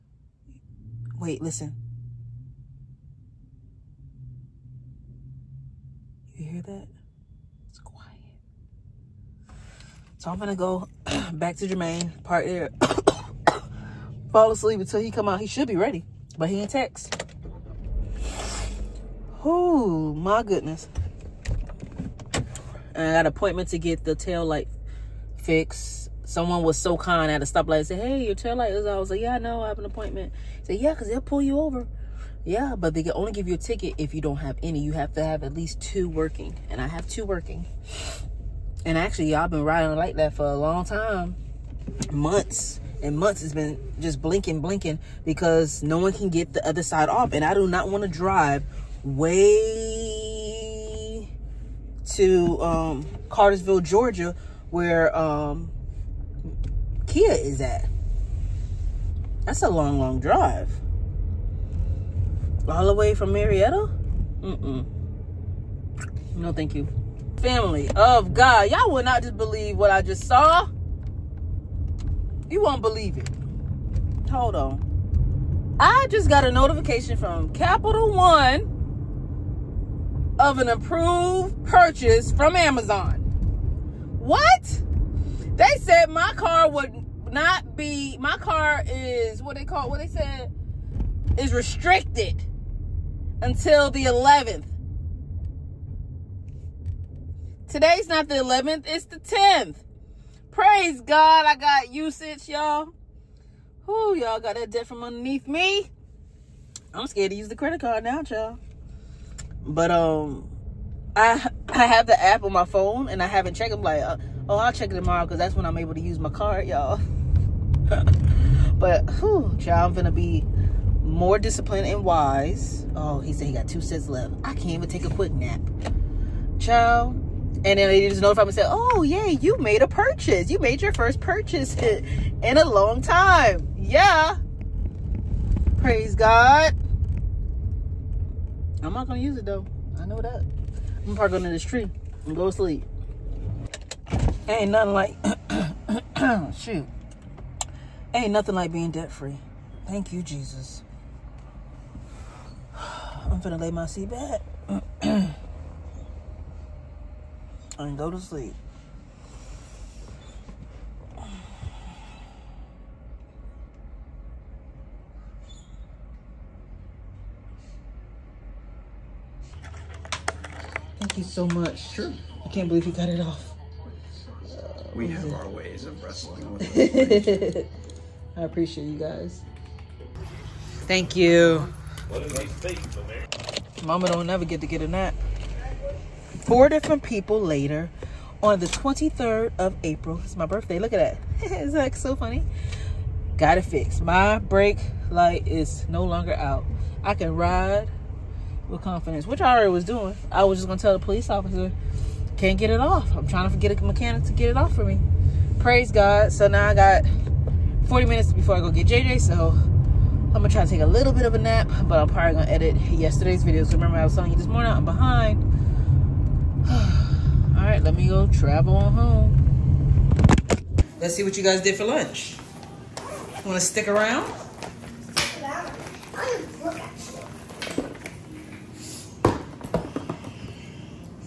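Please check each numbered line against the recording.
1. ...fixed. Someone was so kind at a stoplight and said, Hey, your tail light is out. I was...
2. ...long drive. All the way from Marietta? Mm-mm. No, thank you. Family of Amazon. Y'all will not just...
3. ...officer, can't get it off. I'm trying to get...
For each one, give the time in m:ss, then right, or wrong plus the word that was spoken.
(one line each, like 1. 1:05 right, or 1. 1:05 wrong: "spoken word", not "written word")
1. 0:25 right
2. 0:59 wrong: "God", not "Amazon"
3. 3:21 right.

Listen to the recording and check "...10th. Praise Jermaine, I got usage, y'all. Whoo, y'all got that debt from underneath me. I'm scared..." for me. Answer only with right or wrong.
wrong.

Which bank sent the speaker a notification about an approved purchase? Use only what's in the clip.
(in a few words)
Capital One.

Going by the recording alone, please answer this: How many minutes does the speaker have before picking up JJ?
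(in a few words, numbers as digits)
40.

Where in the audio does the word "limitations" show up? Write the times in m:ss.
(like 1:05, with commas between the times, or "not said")
not said.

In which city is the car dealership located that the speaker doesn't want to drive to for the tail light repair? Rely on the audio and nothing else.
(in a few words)
Cartersville, Georgia.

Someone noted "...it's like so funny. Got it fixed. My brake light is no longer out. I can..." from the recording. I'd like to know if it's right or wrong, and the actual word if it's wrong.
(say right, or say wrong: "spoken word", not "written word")
right.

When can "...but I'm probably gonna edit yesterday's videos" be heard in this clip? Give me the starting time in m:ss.
3:31.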